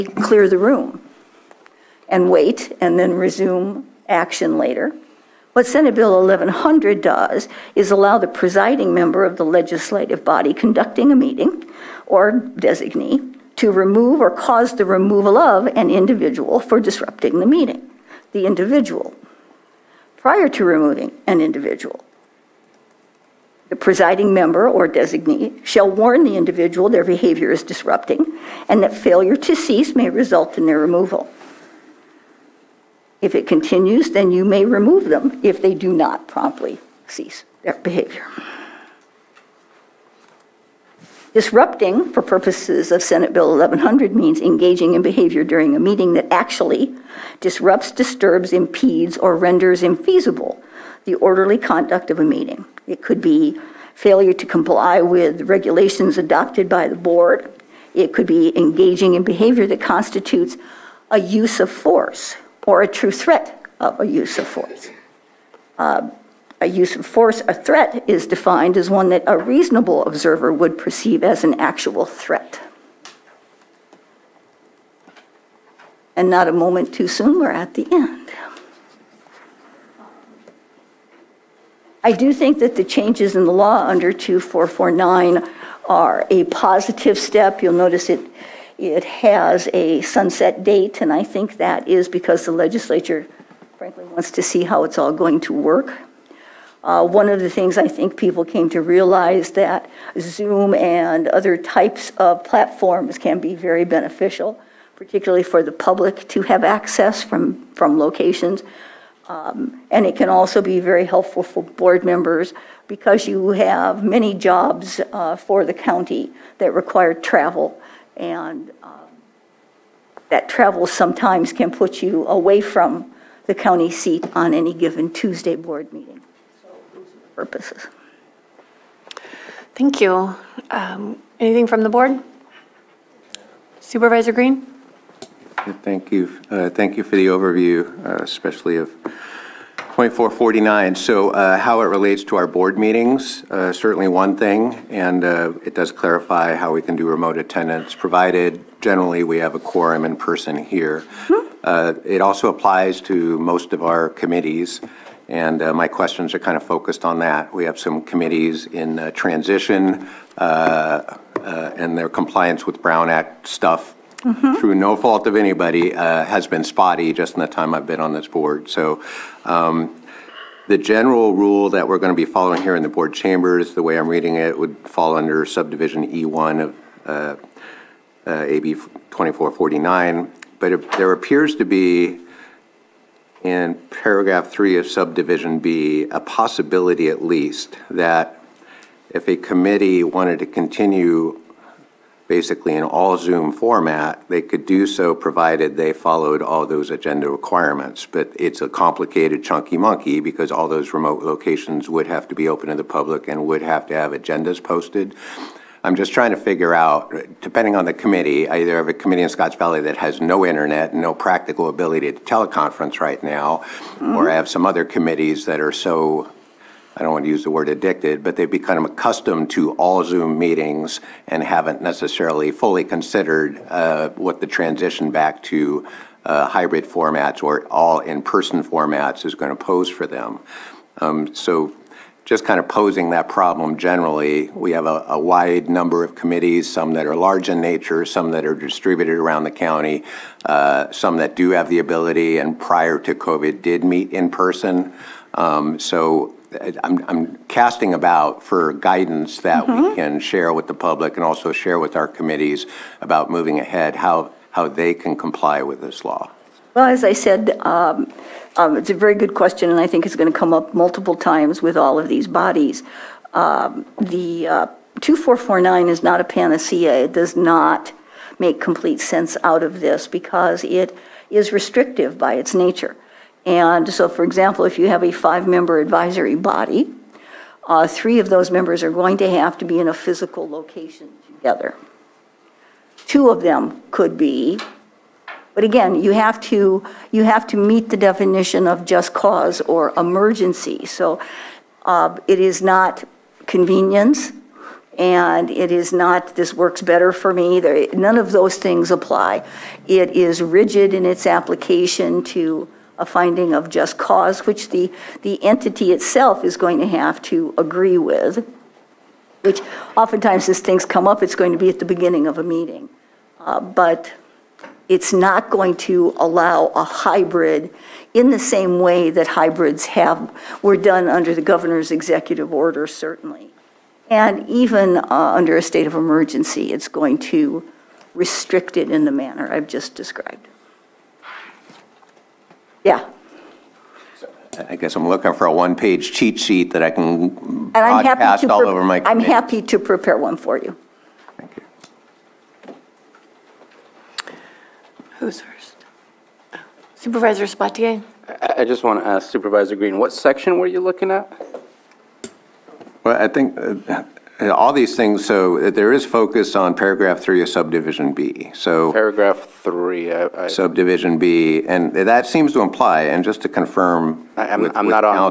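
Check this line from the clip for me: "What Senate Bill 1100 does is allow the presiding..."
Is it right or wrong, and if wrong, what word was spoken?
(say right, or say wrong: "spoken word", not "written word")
right.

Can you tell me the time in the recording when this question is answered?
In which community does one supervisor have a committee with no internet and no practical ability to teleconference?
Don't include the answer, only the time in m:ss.
3:29.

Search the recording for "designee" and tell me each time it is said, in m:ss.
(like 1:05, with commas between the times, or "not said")
0:12, 0:24.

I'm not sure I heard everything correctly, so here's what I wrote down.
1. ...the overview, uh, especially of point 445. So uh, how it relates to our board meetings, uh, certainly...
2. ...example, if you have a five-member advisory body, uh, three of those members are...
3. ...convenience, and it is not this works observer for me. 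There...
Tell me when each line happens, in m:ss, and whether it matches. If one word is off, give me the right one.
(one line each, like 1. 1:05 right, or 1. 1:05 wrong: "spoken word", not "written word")
1. 2:17 wrong: "449", not "445"
2. 4:34 right
3. 4:53 wrong: "better", not "observer".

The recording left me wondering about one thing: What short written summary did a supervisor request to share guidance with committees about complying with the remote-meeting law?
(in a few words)
one-page cheat sheet.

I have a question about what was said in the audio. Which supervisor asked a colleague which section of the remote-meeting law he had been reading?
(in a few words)
Supervisor Sabatier.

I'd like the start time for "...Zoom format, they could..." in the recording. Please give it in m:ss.
3:13.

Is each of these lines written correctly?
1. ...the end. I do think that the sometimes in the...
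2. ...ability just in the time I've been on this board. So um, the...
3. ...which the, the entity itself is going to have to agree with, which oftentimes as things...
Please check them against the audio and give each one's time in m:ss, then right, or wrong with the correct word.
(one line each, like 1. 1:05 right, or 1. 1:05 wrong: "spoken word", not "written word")
1. 1:17 wrong: "changes", not "sometimes"
2. 2:46 wrong: "spotty", not "ability"
3. 5:04 right.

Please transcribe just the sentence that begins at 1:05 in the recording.
Uh, a use of force, a threat is defined as one that a reasonable observer would perceive as an actual threat.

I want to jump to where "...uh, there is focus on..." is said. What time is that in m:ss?
5:55.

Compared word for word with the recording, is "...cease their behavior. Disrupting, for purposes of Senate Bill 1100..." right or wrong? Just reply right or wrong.
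right.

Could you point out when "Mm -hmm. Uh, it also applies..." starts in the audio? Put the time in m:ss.
2:31.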